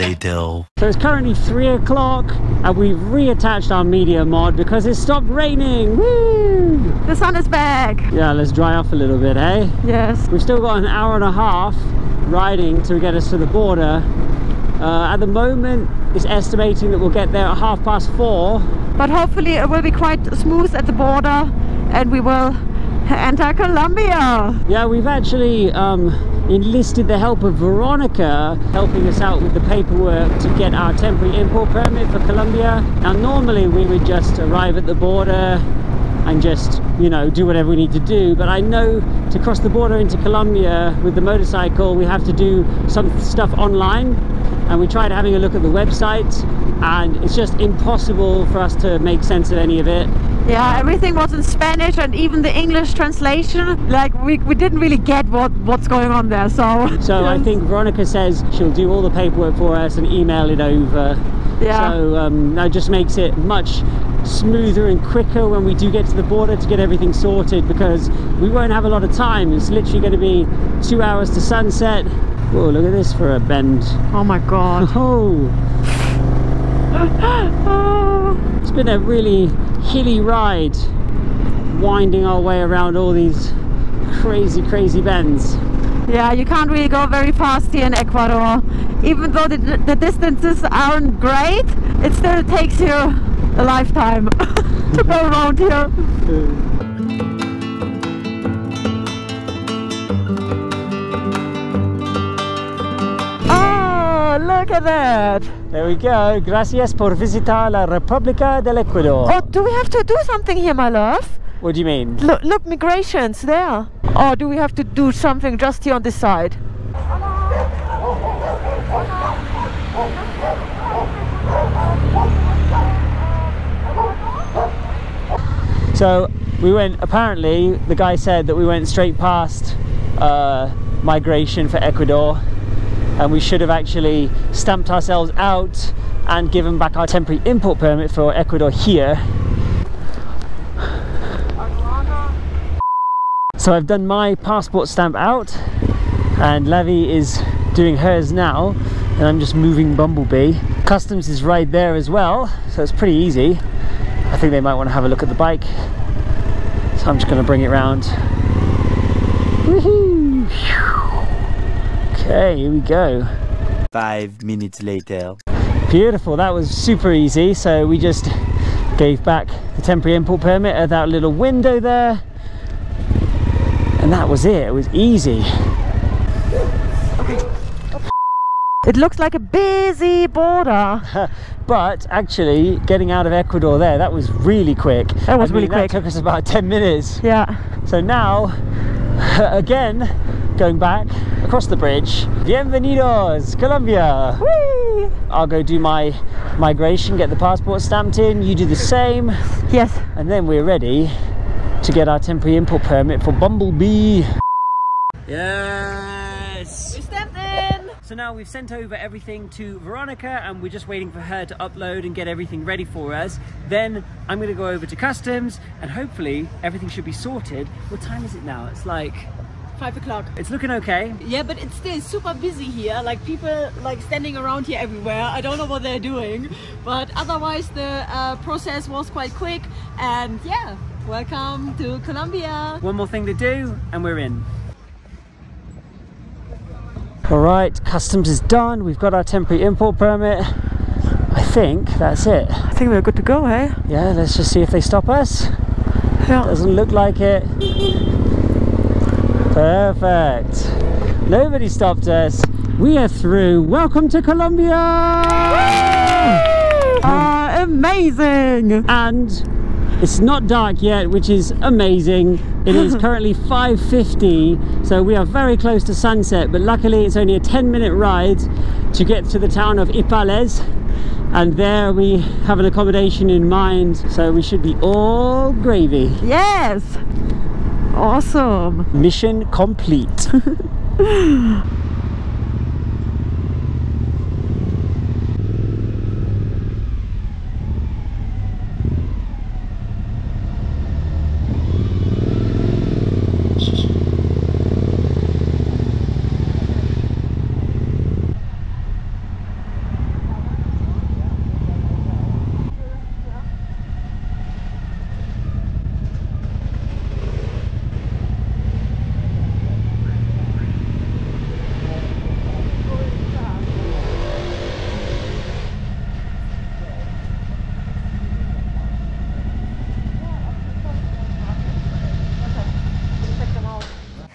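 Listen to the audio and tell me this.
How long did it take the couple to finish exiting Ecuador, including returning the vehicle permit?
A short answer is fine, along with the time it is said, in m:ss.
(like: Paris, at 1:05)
10 minutes, at 3:06.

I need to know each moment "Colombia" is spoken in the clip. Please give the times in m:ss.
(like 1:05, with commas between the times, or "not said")
0:23, 0:32, 0:40, 3:13, 3:51, 4:14.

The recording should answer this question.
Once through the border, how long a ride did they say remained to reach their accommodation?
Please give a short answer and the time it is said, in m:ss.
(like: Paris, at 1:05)
10 minutes, at 4:27.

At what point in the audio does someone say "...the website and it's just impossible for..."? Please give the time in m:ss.
0:45.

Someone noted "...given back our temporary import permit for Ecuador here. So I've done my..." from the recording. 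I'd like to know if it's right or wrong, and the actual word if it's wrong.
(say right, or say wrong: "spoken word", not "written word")
right.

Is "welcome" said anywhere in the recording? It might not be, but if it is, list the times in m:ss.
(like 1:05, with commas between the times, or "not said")
3:51, 4:13.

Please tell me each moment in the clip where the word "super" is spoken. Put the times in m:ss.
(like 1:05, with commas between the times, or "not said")
2:46, 3:42.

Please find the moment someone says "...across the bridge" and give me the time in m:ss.
3:11.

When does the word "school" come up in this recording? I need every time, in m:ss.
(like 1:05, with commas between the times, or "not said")
not said.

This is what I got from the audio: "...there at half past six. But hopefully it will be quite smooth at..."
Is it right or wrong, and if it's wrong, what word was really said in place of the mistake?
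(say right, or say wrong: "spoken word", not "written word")
wrong: "four", not "six".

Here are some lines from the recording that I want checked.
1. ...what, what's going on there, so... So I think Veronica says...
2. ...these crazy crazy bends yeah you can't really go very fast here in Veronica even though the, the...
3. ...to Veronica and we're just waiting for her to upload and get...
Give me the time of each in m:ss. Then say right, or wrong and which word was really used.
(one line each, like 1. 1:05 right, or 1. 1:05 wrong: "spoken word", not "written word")
1. 0:55 right
2. 1:23 wrong: "Ecuador", not "Veronica"
3. 3:29 right.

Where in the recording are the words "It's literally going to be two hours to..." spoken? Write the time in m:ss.
1:09.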